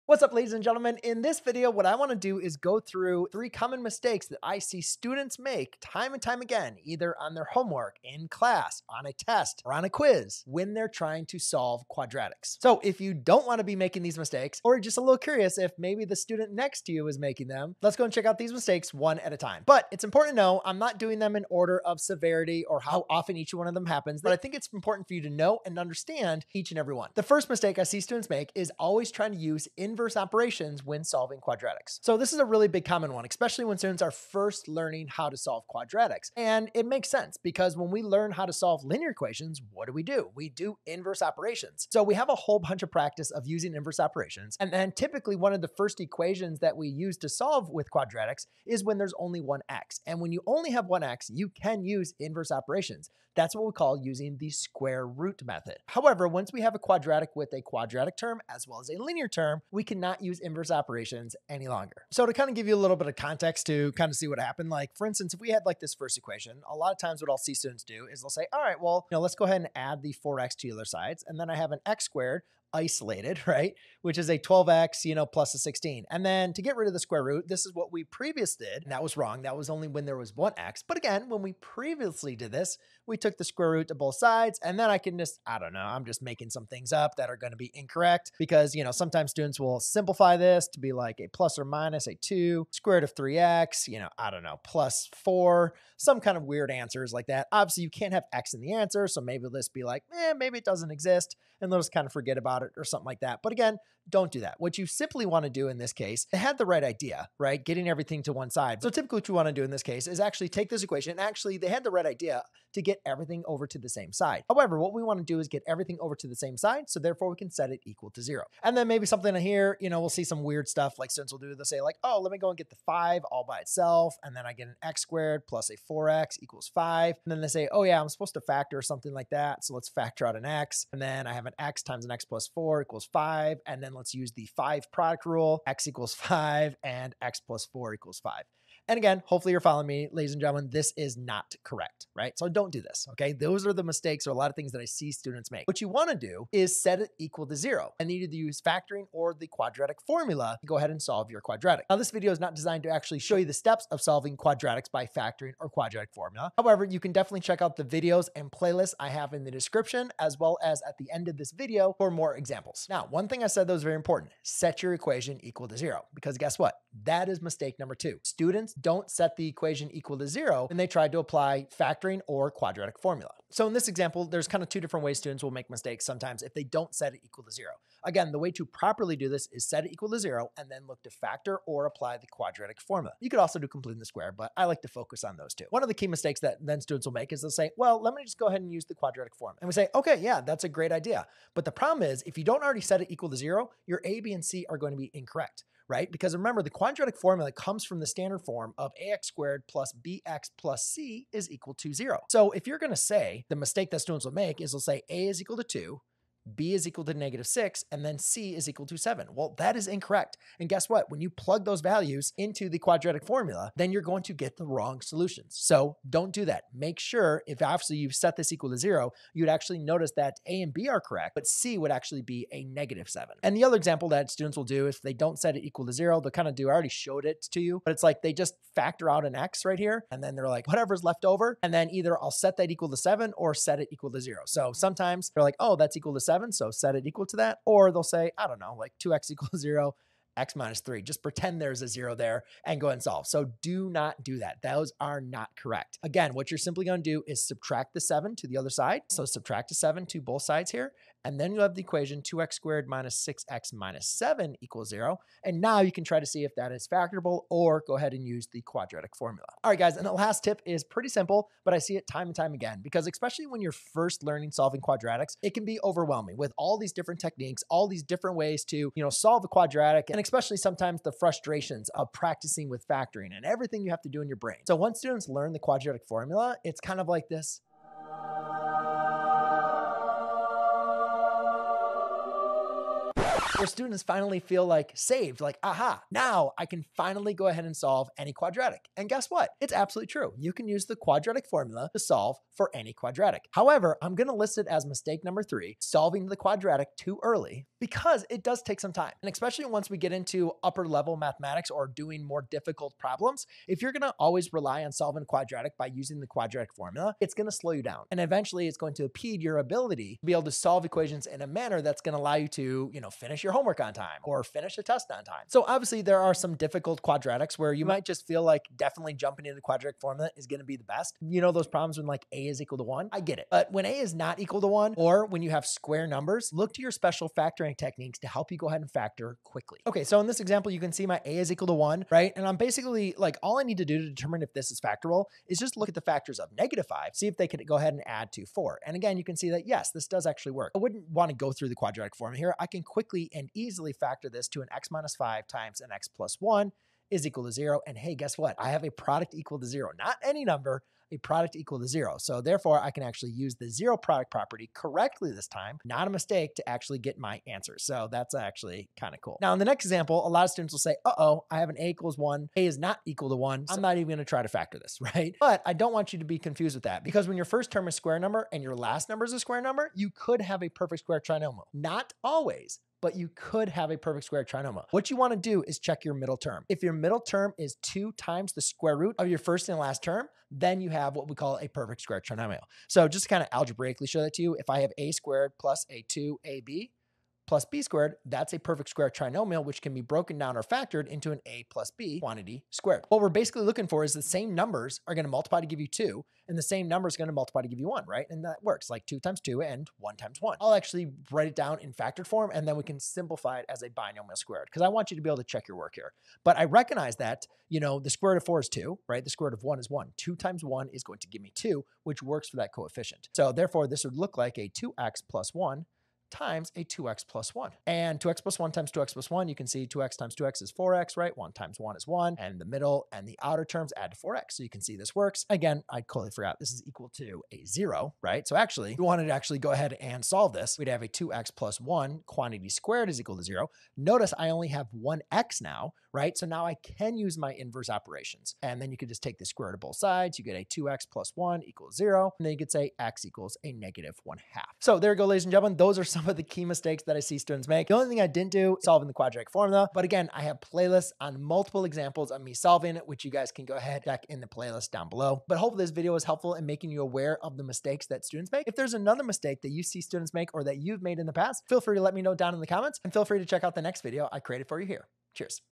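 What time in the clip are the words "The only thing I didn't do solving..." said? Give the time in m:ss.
7:27.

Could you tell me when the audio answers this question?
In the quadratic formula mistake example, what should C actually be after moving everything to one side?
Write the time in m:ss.
3:42.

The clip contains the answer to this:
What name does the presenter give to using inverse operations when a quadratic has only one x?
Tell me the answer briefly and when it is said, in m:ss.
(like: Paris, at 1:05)
the square root method, at 0:54.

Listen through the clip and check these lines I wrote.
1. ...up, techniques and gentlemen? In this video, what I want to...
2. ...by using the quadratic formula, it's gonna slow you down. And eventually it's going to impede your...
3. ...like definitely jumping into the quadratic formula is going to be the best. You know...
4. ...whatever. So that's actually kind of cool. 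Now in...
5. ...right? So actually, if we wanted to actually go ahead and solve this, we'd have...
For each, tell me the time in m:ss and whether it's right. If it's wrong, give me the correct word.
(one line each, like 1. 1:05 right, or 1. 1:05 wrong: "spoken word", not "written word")
1. 0:00 wrong: "ladies", not "techniques"
2. 5:05 right
3. 5:18 right
4. 5:57 wrong: "answer", not "whatever"
5. 7:08 right.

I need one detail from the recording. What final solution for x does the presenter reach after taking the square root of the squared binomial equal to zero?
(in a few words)
-1/2.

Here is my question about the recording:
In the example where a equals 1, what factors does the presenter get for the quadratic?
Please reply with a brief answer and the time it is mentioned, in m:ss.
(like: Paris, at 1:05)
(x - 5)(x + 1), at 5:44.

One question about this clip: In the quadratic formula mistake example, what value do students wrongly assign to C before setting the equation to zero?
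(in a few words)
7.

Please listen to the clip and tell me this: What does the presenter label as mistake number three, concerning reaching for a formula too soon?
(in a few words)
solving the quadratic too early.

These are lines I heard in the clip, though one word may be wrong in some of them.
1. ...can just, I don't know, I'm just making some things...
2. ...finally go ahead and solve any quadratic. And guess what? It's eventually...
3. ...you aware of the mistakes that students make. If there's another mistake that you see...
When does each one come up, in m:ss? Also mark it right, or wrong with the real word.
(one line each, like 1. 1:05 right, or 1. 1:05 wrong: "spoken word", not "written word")
1. 1:24 right
2. 4:46 wrong: "absolutely", not "eventually"
3. 7:36 right.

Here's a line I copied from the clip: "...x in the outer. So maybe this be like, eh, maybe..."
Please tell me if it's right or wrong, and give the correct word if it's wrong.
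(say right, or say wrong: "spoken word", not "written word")
wrong: "answer", not "outer".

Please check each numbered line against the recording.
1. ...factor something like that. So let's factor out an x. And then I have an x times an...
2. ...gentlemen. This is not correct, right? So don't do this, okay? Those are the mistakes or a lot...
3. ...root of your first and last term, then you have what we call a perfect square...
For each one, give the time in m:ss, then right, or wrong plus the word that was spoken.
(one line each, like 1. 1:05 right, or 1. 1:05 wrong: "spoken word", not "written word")
1. 2:08 right
2. 2:20 right
3. 6:18 right.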